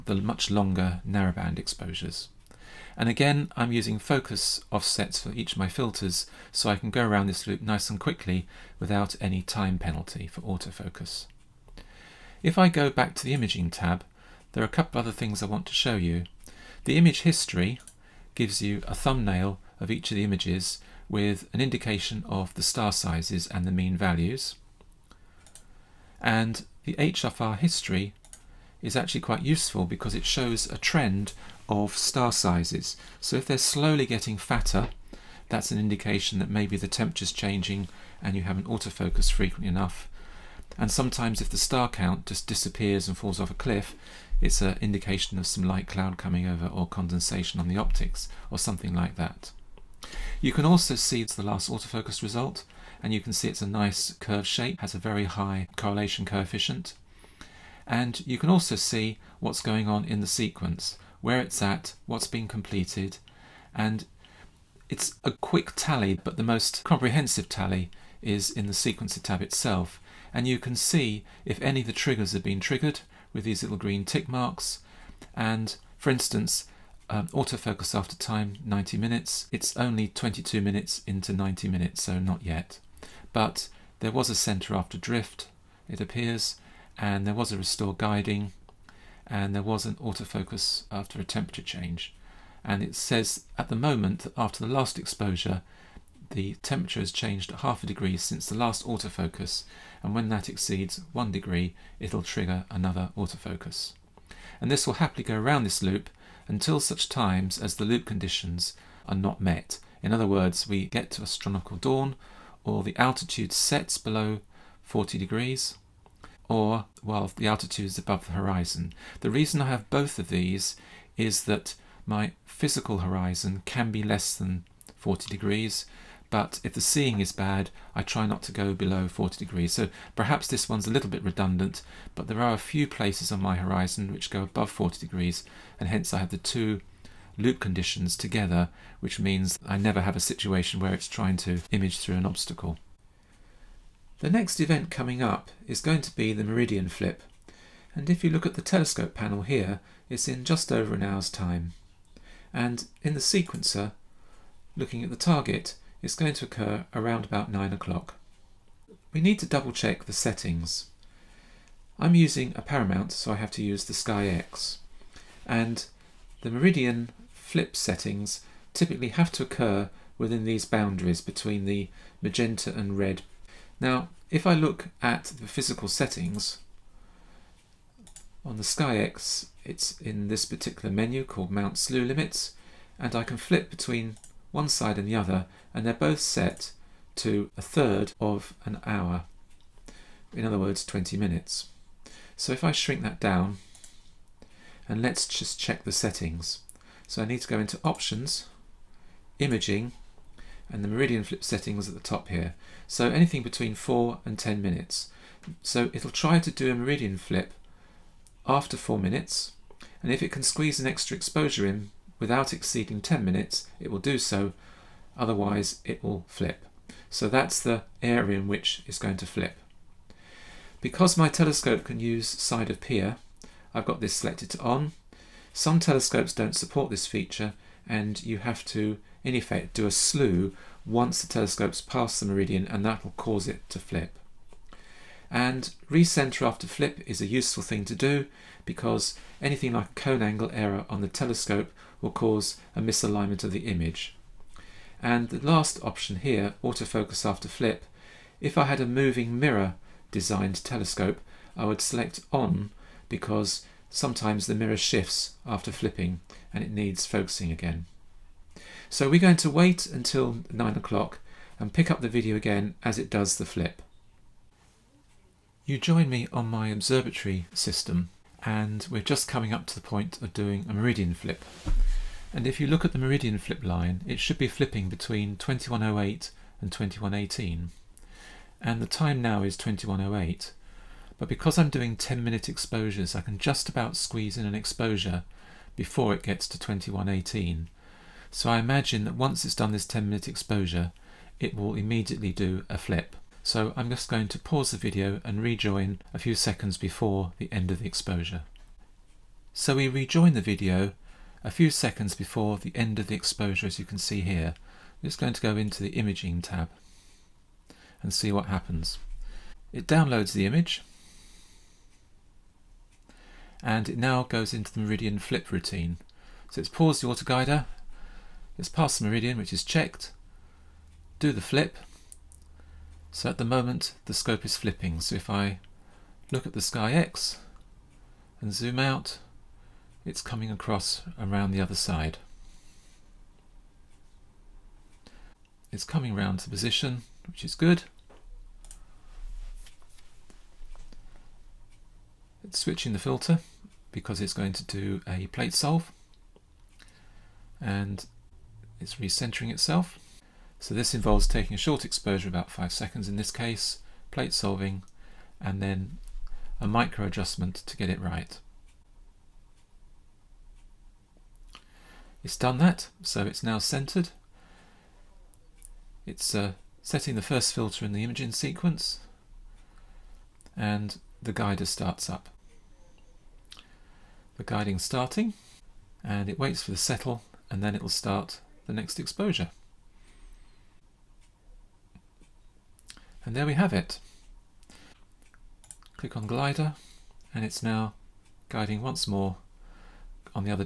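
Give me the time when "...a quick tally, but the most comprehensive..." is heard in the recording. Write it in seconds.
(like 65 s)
65 s.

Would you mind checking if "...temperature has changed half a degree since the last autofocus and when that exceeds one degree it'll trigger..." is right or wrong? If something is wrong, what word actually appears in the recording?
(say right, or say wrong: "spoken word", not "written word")
right.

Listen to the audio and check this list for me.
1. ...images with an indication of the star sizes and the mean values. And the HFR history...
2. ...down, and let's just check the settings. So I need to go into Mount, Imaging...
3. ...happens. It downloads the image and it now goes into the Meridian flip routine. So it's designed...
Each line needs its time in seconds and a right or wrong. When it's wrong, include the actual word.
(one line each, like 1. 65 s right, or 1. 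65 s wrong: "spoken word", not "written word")
1. 20 s right
2. 193 s wrong: "Options", not "Mount"
3. 308 s wrong: "paused", not "designed".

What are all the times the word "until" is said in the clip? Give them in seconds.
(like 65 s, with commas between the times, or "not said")
106 s, 259 s.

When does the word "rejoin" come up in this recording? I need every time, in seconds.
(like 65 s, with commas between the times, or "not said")
295 s, 299 s.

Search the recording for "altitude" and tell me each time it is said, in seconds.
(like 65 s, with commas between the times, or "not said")
112 s, 117 s.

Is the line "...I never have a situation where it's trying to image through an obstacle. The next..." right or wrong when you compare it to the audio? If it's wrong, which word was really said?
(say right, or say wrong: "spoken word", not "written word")
right.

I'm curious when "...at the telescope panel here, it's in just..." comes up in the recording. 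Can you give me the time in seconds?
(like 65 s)
148 s.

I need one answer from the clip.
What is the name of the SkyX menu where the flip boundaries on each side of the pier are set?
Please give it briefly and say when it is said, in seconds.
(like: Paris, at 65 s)
Mount Slew Limits, at 181 s.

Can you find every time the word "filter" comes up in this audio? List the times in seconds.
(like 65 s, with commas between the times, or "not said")
5 s, 342 s, 367 s.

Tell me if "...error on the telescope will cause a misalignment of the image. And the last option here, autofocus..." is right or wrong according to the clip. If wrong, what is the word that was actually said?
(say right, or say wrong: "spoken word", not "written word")
right.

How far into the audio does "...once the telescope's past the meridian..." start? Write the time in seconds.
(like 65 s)
230 s.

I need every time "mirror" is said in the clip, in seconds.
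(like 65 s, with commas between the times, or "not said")
249 s, 254 s.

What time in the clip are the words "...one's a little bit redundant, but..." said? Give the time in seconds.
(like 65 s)
130 s.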